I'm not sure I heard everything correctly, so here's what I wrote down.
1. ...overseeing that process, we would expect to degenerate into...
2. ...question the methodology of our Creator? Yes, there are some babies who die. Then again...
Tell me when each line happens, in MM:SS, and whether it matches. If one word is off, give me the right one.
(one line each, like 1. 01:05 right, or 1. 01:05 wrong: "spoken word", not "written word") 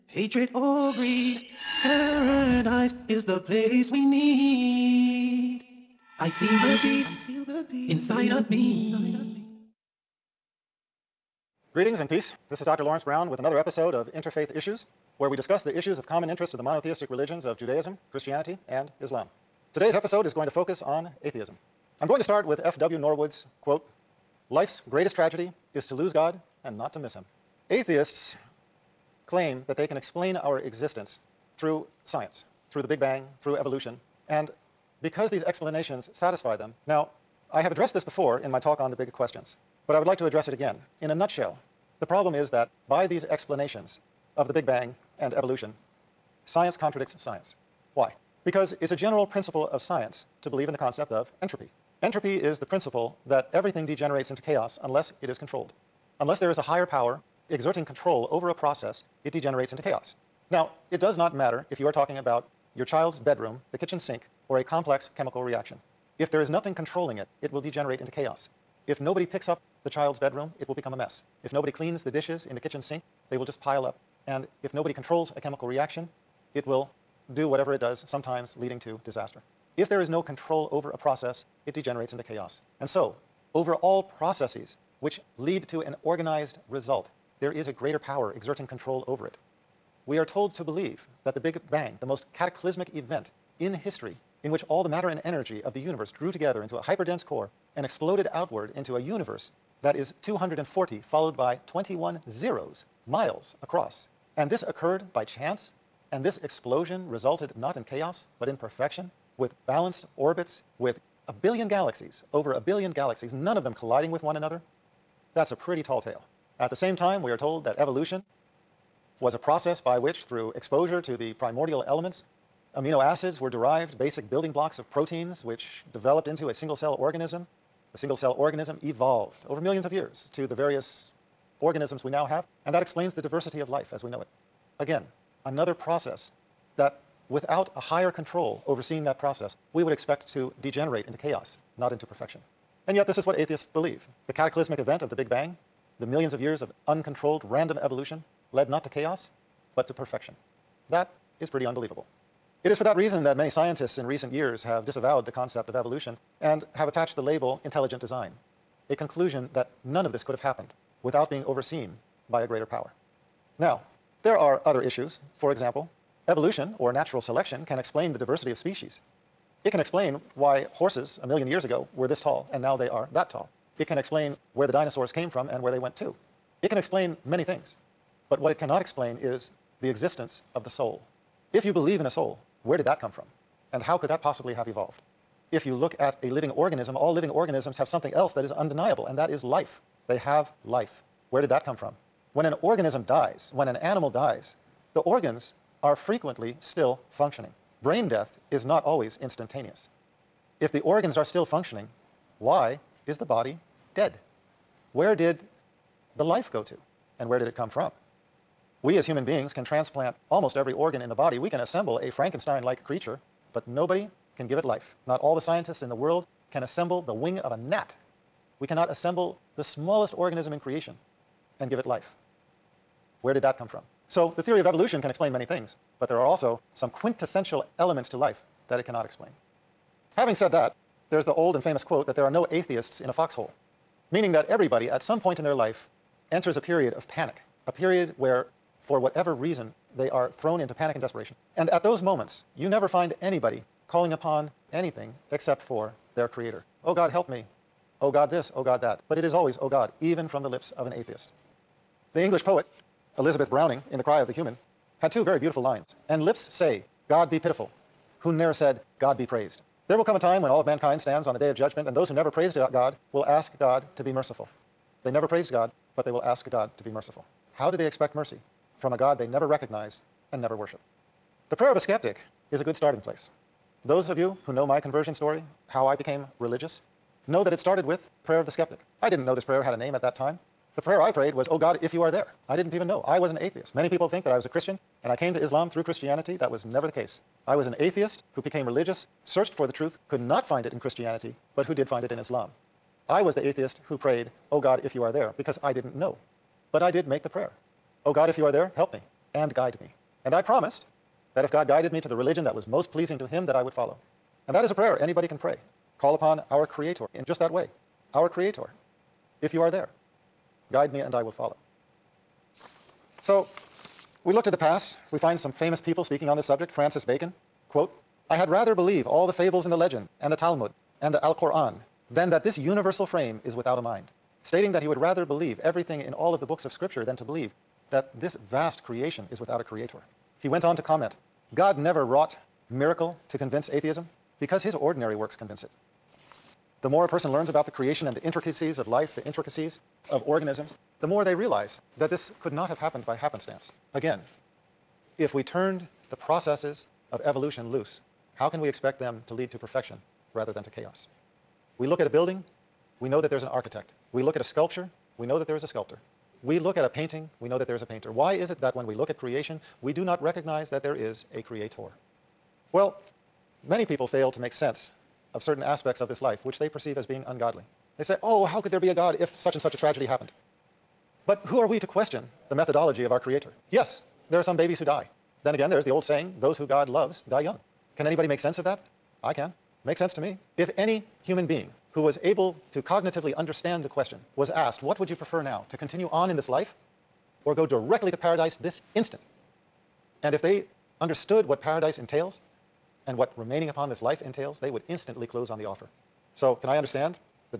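1. 02:18 right
2. 06:11 right.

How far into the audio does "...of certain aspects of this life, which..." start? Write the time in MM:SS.
06:05.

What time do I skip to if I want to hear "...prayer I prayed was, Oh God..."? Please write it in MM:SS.
04:40.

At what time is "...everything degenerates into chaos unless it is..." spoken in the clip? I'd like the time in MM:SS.
00:53.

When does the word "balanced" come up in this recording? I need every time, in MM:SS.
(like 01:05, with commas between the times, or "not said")
01:49.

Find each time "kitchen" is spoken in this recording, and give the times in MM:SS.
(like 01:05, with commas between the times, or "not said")
01:03, 01:12.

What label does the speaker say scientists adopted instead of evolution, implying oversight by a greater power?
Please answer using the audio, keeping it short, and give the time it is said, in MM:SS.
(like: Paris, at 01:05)
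Intelligent design, at 02:37.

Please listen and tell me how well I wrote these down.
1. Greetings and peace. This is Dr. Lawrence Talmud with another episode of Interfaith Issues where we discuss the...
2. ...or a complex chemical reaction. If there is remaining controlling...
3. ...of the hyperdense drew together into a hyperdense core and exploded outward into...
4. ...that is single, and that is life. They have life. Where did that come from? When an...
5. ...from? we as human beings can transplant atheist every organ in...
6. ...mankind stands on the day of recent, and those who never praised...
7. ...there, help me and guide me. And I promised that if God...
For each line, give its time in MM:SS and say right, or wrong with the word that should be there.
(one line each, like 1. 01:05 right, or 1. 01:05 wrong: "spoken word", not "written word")
1. 00:11 wrong: "Brown", not "Talmud"
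2. 01:04 wrong: "nothing", not "remaining"
3. 01:35 wrong: "universe", not "hyperdense"
4. 03:08 wrong: "undeniable", not "single"
5. 03:27 wrong: "almost", not "atheist"
6. 04:20 wrong: "judgment", not "recent"
7. 04:58 right.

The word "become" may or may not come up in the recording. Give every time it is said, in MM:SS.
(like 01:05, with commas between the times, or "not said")
01:10.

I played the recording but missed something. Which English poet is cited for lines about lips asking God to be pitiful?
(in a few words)
Elizabeth Browning.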